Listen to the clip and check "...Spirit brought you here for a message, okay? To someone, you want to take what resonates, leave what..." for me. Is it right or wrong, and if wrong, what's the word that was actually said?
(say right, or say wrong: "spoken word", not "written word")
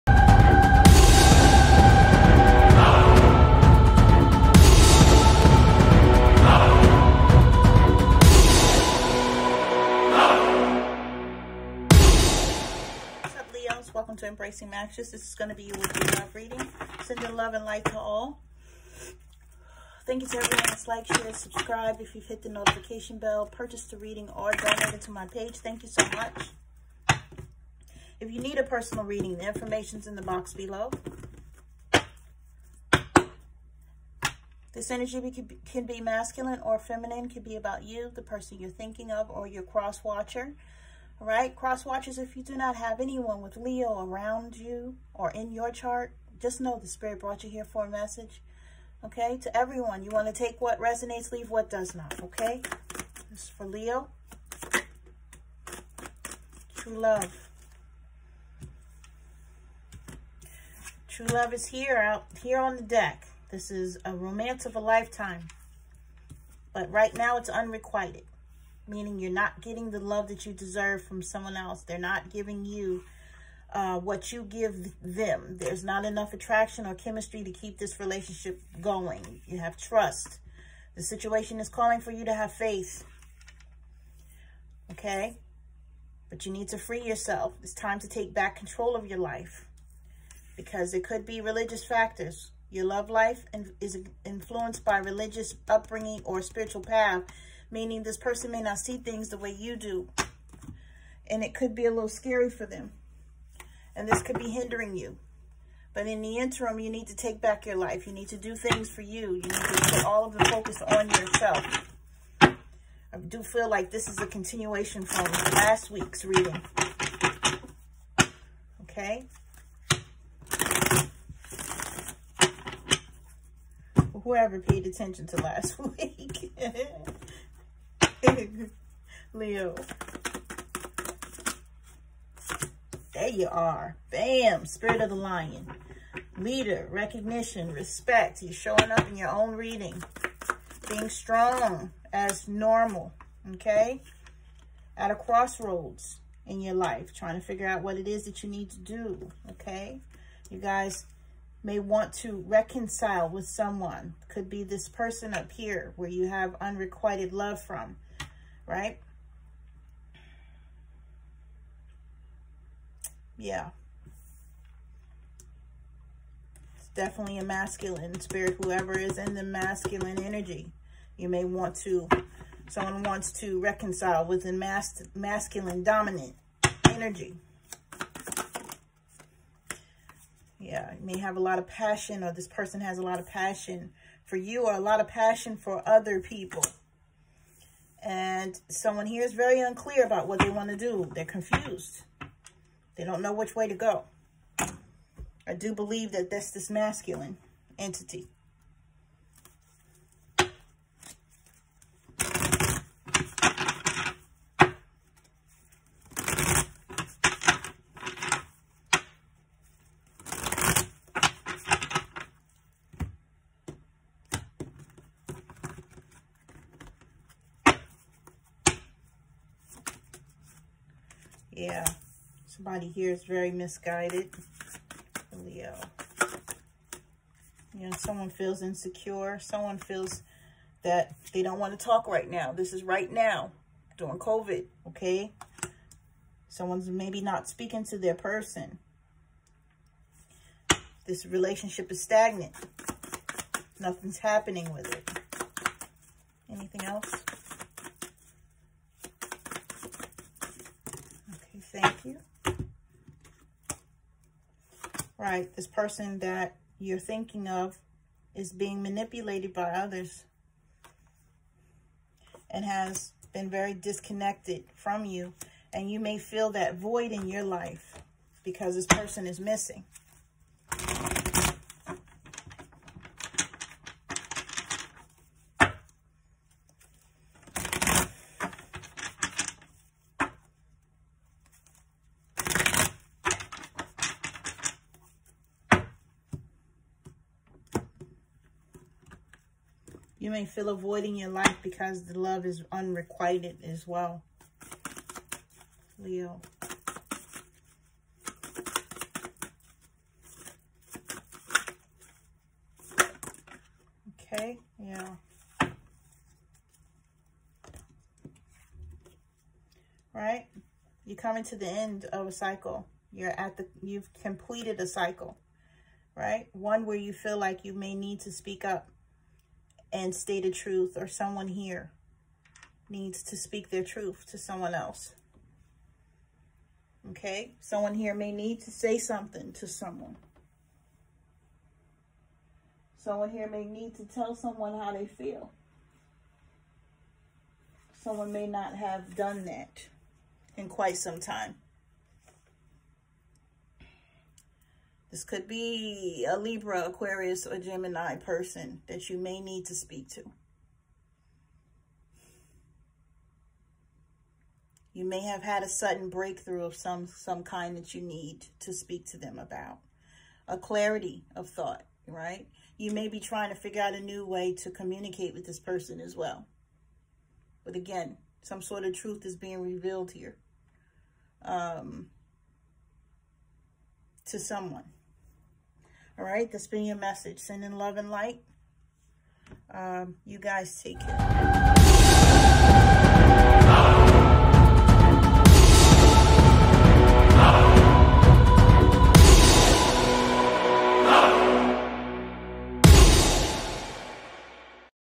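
wrong: "everyone", not "someone".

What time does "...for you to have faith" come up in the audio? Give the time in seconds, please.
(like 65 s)
82 s.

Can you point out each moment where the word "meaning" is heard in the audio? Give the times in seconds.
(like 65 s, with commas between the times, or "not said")
68 s, 97 s.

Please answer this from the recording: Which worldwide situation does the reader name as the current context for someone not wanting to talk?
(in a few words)
COVID.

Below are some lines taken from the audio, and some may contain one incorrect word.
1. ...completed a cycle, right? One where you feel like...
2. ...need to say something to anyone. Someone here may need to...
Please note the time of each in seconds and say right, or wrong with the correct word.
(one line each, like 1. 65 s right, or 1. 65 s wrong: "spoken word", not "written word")
1. 314 s right
2. 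328 s wrong: "someone", not "anyone".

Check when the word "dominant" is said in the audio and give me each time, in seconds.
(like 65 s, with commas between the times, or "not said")
175 s.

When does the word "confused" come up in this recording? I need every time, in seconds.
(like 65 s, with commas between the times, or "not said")
191 s.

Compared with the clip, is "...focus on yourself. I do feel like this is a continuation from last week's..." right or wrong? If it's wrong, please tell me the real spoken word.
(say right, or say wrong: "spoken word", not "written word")
right.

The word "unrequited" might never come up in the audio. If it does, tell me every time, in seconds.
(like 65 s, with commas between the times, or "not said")
67 s, 156 s, 292 s.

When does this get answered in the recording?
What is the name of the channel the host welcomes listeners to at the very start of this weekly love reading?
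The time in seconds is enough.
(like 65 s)
14 s.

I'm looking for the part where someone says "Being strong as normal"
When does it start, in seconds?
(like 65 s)
140 s.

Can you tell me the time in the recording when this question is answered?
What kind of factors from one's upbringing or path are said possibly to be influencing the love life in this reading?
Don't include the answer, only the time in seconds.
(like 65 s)
91 s.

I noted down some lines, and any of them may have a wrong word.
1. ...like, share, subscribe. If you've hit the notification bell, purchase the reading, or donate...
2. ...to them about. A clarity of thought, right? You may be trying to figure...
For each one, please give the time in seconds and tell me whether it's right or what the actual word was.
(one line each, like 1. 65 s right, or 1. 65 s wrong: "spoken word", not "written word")
1. 20 s right
2. 359 s right.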